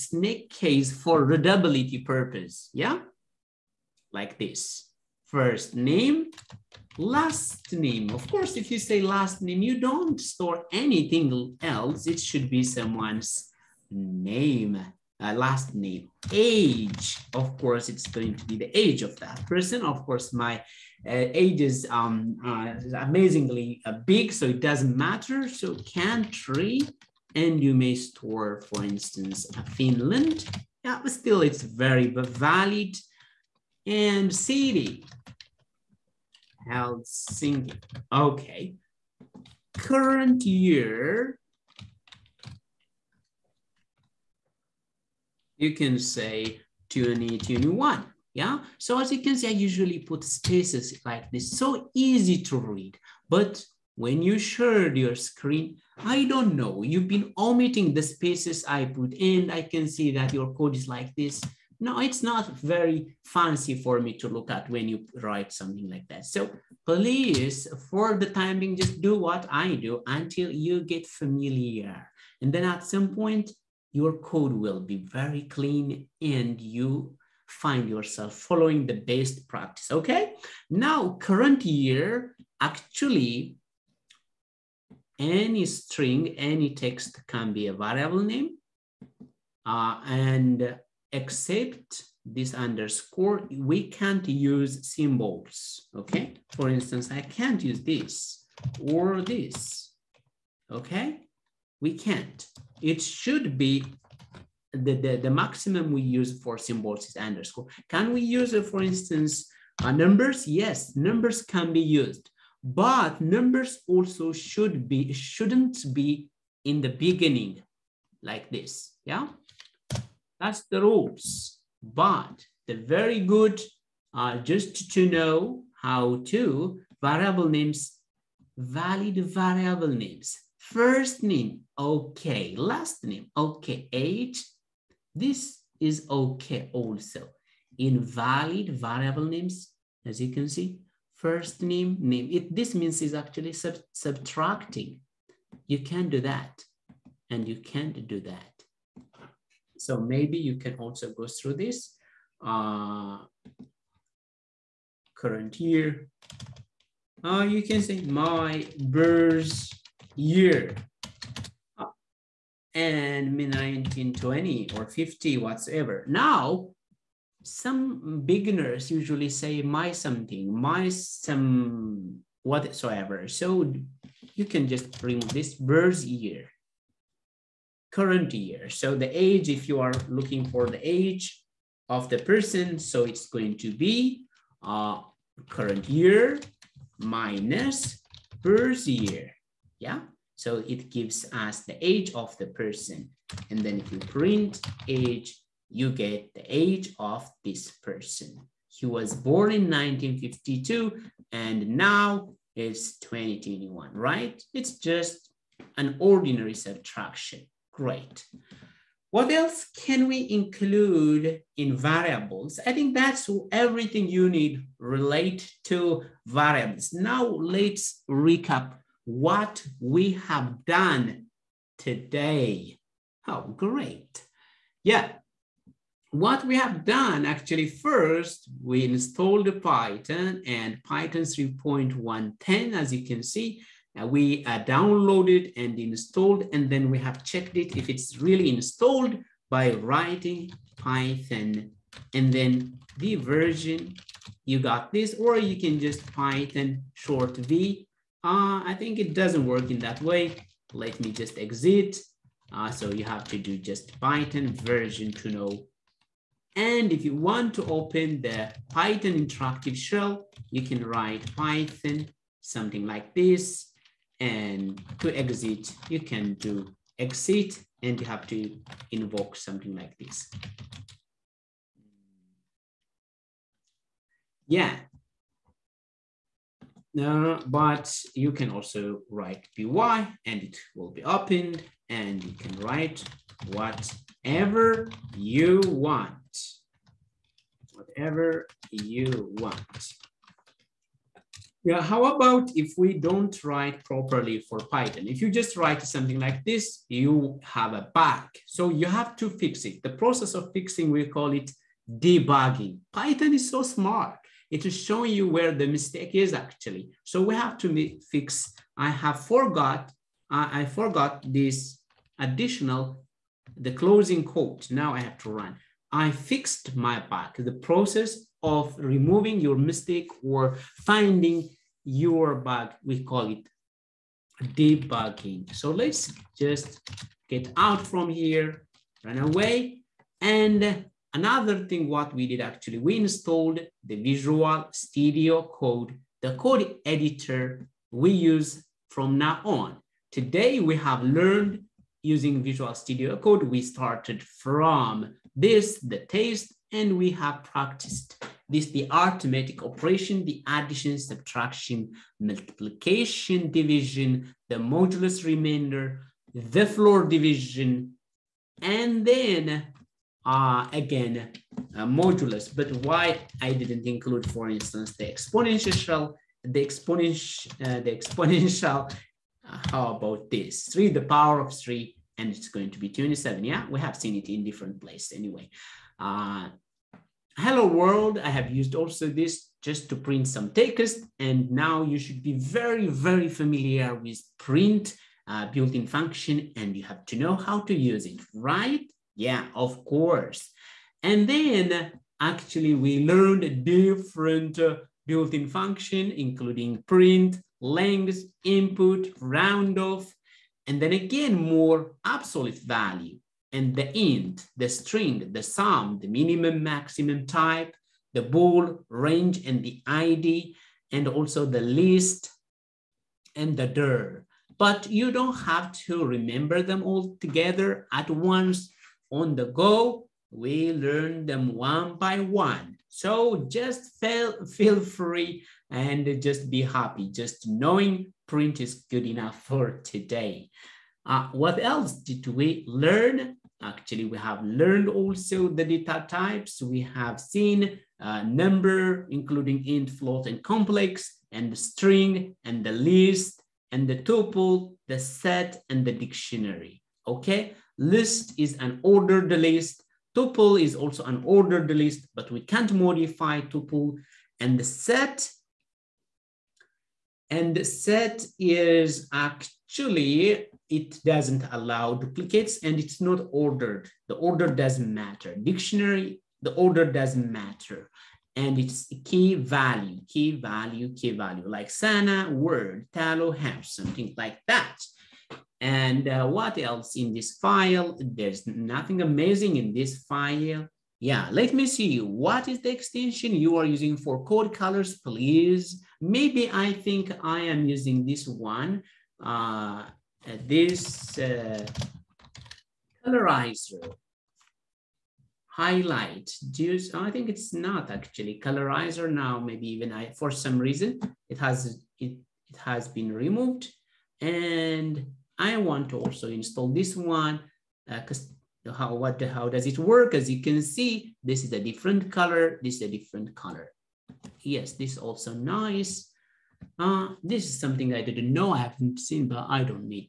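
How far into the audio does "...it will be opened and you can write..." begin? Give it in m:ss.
4:40.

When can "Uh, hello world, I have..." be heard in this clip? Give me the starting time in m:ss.
6:15.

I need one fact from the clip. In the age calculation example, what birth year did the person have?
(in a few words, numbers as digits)
1952.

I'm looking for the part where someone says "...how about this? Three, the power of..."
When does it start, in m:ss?
6:09.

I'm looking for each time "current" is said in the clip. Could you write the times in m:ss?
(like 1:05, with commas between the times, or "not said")
0:39, 1:21, 2:35, 2:58, 3:05.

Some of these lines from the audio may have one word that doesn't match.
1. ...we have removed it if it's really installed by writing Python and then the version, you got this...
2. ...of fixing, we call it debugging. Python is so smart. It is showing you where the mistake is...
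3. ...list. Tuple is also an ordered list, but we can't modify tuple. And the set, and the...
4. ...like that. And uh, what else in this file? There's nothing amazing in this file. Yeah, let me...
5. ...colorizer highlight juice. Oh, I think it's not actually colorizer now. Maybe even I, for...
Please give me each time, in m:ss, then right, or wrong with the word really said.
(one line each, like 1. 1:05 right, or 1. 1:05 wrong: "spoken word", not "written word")
1. 3:56 wrong: "checked", not "removed"
2. 5:00 right
3. 7:29 right
4. 7:54 right
5. 8:13 right.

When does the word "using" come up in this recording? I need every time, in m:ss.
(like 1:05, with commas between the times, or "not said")
5:42, 8:03, 8:07.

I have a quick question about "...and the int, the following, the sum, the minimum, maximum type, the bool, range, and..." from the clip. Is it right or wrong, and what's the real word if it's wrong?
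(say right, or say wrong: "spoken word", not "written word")
wrong: "string", not "following".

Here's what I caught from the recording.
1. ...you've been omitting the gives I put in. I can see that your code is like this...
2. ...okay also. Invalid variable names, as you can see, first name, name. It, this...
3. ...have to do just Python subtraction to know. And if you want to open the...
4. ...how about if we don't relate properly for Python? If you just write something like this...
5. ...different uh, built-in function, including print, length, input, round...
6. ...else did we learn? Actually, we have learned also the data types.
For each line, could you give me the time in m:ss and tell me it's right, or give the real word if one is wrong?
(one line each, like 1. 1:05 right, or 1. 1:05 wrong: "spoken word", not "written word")
1. 0:56 wrong: "spaces", not "gives"
2. 2:16 right
3. 4:13 wrong: "version", not "subtraction"
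4. 4:51 wrong: "write", not "relate"
5. 6:33 right
6. 7:11 right.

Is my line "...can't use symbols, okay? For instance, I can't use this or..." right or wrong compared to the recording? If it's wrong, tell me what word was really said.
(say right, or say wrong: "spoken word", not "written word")
right.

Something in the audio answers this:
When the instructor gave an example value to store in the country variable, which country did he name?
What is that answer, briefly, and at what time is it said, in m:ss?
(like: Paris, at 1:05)
Finland, at 0:29.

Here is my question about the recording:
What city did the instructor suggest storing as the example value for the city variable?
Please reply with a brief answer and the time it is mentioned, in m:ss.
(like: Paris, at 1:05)
Helsinki, at 0:36.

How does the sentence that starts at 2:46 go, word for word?
Now, some beginners usually say my something, my some whatsoever.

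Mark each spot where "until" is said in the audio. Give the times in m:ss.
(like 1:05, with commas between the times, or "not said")
1:10.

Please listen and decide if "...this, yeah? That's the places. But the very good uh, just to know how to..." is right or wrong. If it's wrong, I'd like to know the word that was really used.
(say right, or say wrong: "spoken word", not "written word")
wrong: "rules", not "places".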